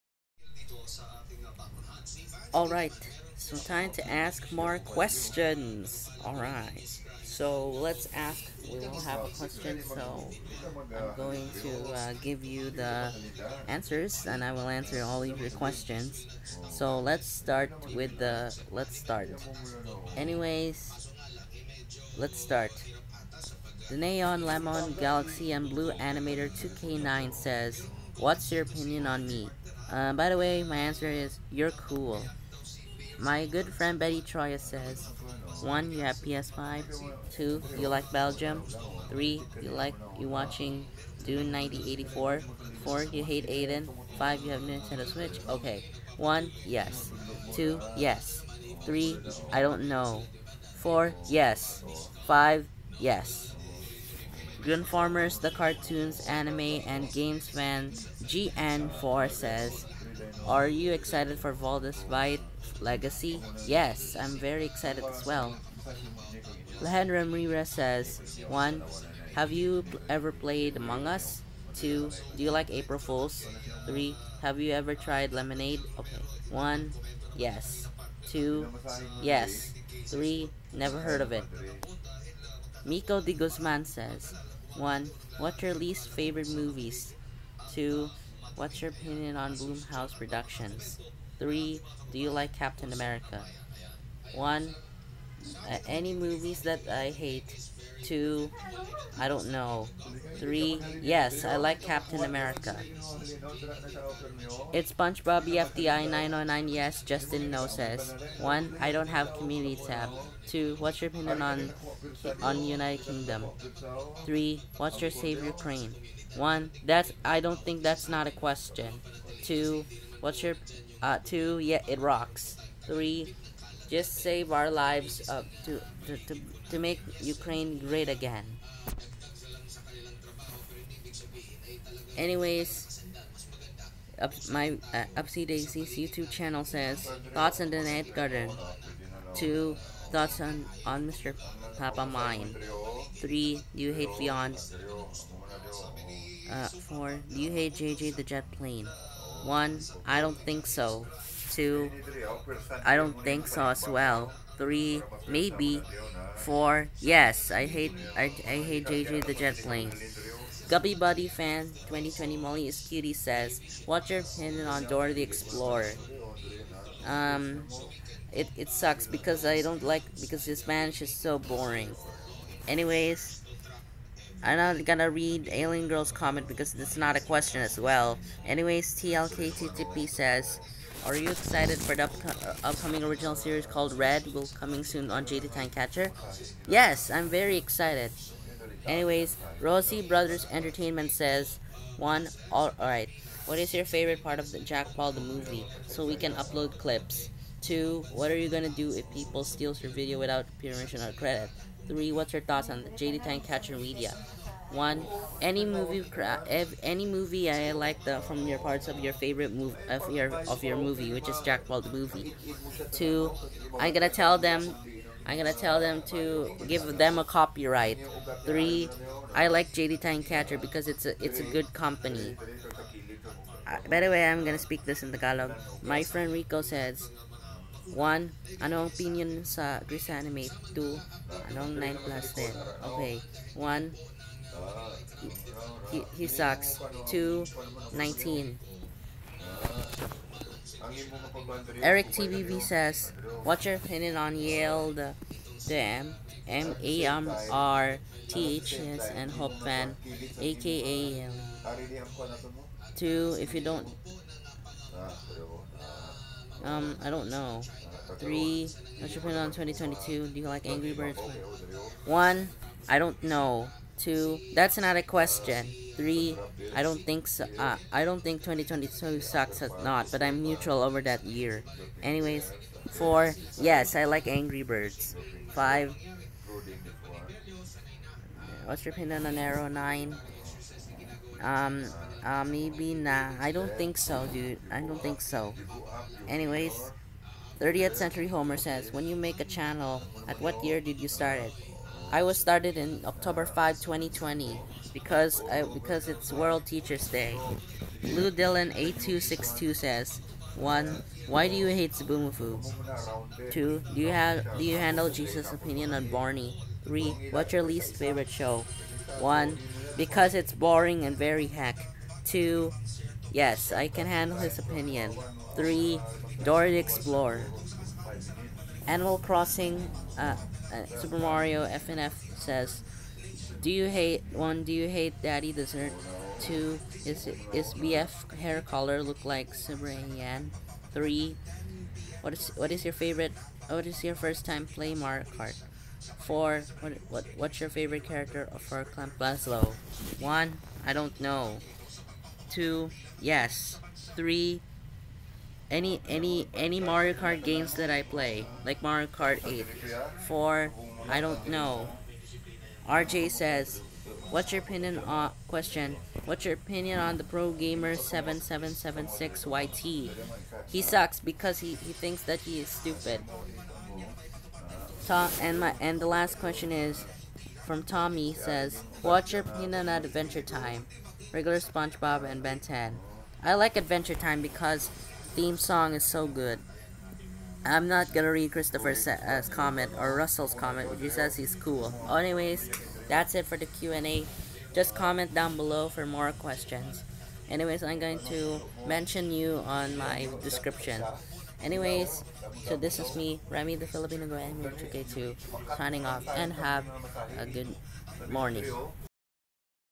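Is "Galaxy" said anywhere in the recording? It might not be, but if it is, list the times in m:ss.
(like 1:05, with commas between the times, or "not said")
0:24.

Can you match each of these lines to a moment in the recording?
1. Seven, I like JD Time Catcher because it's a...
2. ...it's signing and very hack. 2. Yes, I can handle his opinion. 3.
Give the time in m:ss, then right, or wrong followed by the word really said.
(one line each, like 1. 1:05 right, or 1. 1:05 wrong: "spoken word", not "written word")
1. 3:38 wrong: "Three", not "Seven"
2. 5:10 wrong: "boring", not "signing".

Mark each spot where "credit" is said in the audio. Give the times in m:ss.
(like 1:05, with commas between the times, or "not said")
3:21.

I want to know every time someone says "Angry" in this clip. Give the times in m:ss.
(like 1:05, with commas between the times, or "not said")
4:20, 4:34.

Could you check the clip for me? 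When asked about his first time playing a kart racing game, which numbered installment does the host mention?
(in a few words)
Mario Kart 8.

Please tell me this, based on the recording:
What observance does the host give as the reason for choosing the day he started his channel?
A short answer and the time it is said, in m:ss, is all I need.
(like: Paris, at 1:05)
World Teachers Day, at 4:56.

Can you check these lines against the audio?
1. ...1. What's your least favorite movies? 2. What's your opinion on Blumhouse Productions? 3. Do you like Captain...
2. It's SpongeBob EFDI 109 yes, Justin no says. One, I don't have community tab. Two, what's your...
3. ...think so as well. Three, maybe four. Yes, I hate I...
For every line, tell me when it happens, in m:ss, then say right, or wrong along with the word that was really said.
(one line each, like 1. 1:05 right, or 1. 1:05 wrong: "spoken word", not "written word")
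1. 1:24 right
2. 1:44 wrong: "909", not "109"
3. 2:33 right.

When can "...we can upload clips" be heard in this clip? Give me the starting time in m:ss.
3:16.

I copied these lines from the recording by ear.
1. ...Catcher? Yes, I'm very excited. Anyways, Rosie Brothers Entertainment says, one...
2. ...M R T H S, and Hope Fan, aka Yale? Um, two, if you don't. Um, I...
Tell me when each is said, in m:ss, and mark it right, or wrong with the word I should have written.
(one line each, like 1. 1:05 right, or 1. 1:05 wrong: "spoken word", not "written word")
1. 3:05 right
2. 4:07 right.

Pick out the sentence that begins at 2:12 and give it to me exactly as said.
Anyways, up, my uh, Upsy Daisy's YouTube channel says, Thoughts on the Night Garden.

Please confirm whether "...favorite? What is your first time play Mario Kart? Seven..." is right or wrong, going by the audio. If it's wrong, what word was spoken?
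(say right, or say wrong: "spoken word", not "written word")
wrong: "Four", not "Seven".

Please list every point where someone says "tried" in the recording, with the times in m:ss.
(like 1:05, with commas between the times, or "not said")
1:14.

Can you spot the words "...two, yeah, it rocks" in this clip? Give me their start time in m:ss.
2:01.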